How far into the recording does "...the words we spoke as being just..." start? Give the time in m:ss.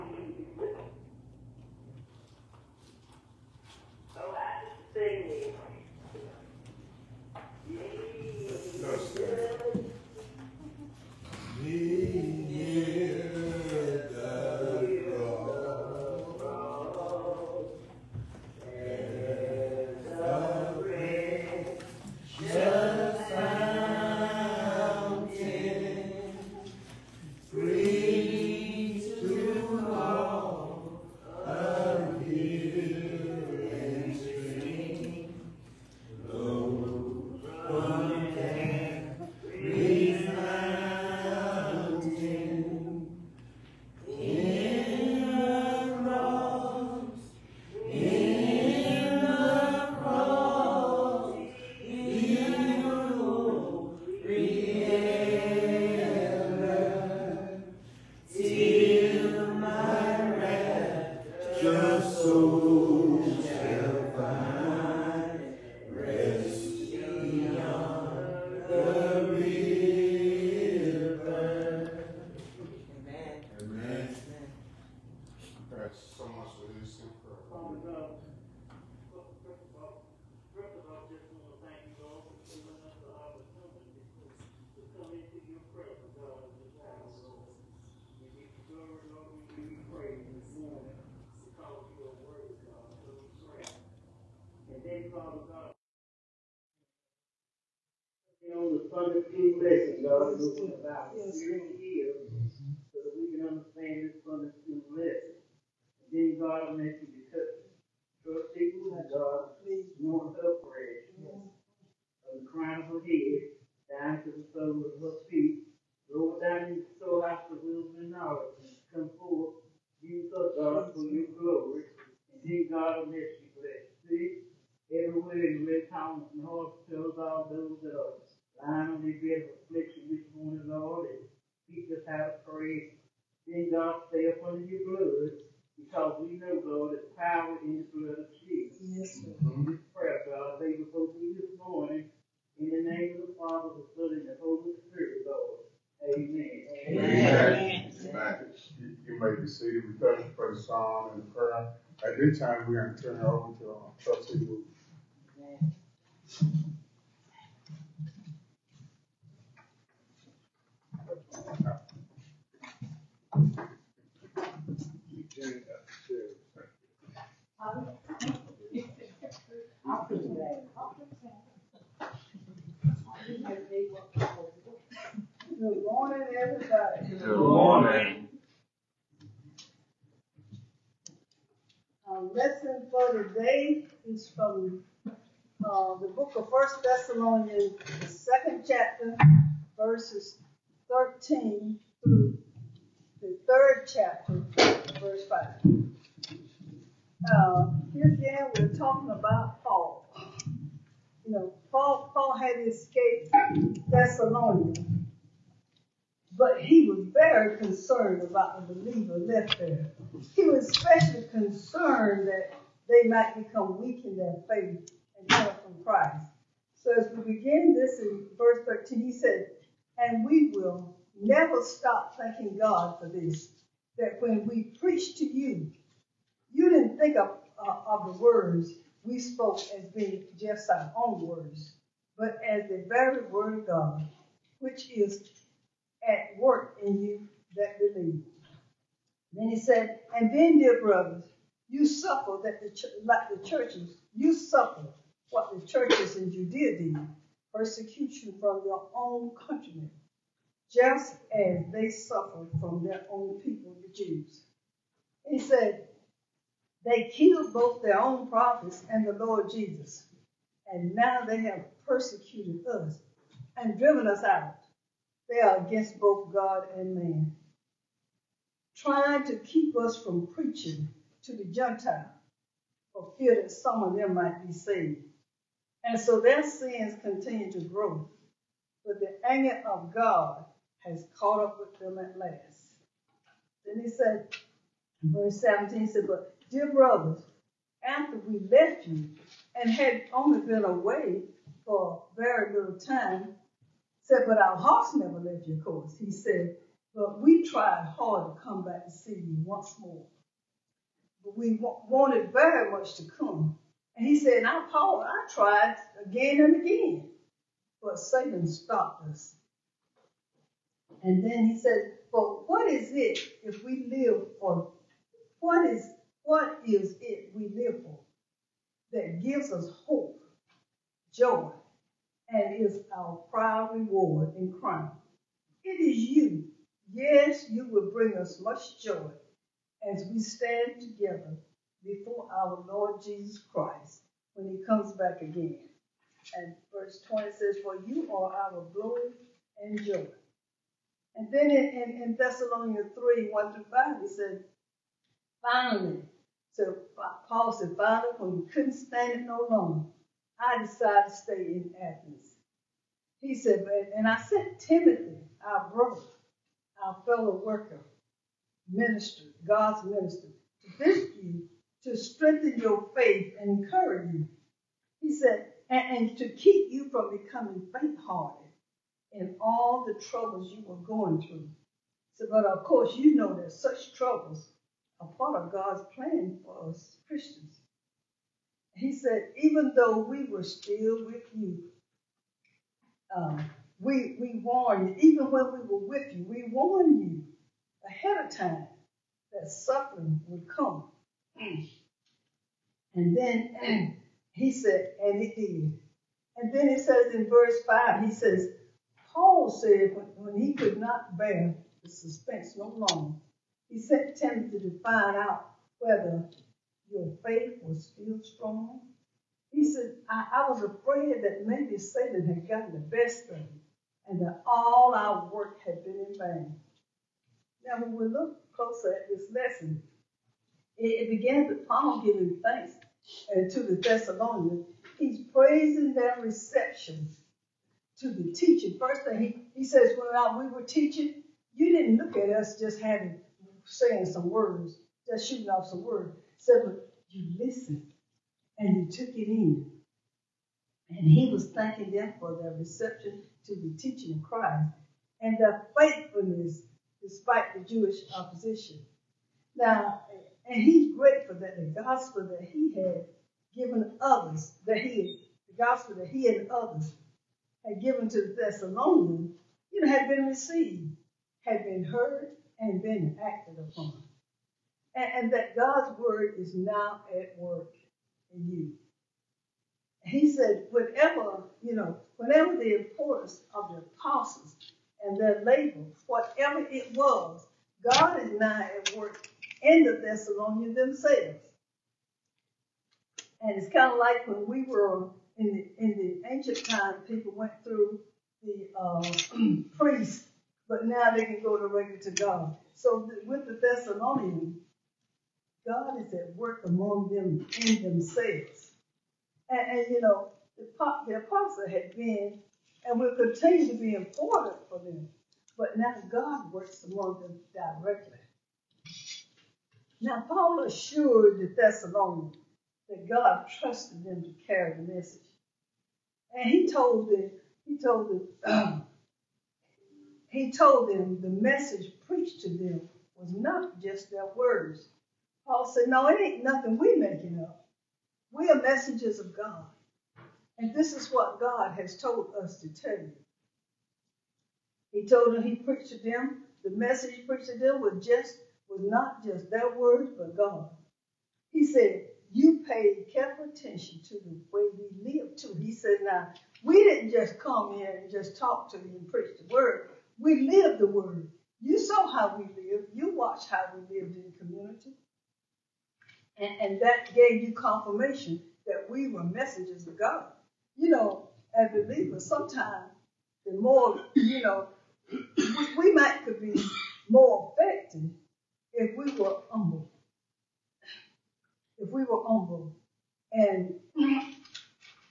3:48.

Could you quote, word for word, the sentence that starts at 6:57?
Now, when we look closer at this lesson, it, it begins with Paul giving thanks uh, to the Thessalonians.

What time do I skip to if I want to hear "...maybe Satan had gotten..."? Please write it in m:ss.
6:51.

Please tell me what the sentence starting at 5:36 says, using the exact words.
And verse 20 says, For you are our glory and joy.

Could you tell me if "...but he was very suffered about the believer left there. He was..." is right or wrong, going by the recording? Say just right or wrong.
wrong.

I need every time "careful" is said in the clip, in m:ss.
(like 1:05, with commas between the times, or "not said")
9:03.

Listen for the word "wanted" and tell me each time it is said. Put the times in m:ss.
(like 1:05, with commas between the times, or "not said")
5:01.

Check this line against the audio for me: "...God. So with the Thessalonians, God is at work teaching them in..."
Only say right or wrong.
wrong.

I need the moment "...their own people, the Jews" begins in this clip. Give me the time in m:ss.
4:12.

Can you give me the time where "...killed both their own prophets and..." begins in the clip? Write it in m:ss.
4:17.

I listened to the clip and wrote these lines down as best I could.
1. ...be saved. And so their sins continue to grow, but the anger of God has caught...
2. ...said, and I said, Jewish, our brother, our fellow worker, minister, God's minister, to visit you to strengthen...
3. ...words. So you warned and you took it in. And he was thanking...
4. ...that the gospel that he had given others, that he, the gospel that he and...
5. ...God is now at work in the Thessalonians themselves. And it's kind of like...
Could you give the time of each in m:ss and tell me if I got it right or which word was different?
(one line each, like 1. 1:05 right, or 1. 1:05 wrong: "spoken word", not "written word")
1. 4:34 right
2. 5:53 wrong: "Timothy", not "Jewish"
3. 7:15 wrong: "listened", not "warned"
4. 7:31 right
5. 7:57 right.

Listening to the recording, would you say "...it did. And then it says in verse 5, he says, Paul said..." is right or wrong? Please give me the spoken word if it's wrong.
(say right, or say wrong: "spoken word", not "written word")
right.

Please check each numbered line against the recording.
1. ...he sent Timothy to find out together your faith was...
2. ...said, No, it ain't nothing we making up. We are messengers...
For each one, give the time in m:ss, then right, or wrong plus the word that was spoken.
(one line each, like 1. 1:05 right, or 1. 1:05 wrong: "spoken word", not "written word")
1. 6:43 wrong: "whether", not "together"
2. 8:45 right.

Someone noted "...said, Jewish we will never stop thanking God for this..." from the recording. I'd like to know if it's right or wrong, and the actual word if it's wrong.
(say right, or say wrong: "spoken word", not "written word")
wrong: "And", not "Jewish".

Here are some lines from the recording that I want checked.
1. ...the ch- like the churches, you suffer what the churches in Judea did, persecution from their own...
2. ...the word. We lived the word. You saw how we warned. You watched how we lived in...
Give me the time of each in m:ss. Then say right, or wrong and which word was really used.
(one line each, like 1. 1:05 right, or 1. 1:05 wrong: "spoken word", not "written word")
1. 4:02 right
2. 9:09 wrong: "lived", not "warned".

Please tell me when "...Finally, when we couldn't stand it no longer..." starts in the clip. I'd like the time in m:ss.
5:47.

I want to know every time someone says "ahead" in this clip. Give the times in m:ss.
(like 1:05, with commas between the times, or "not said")
6:27.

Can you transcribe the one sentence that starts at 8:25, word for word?
But now God works among them directly.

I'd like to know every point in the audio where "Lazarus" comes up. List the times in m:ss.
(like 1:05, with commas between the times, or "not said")
not said.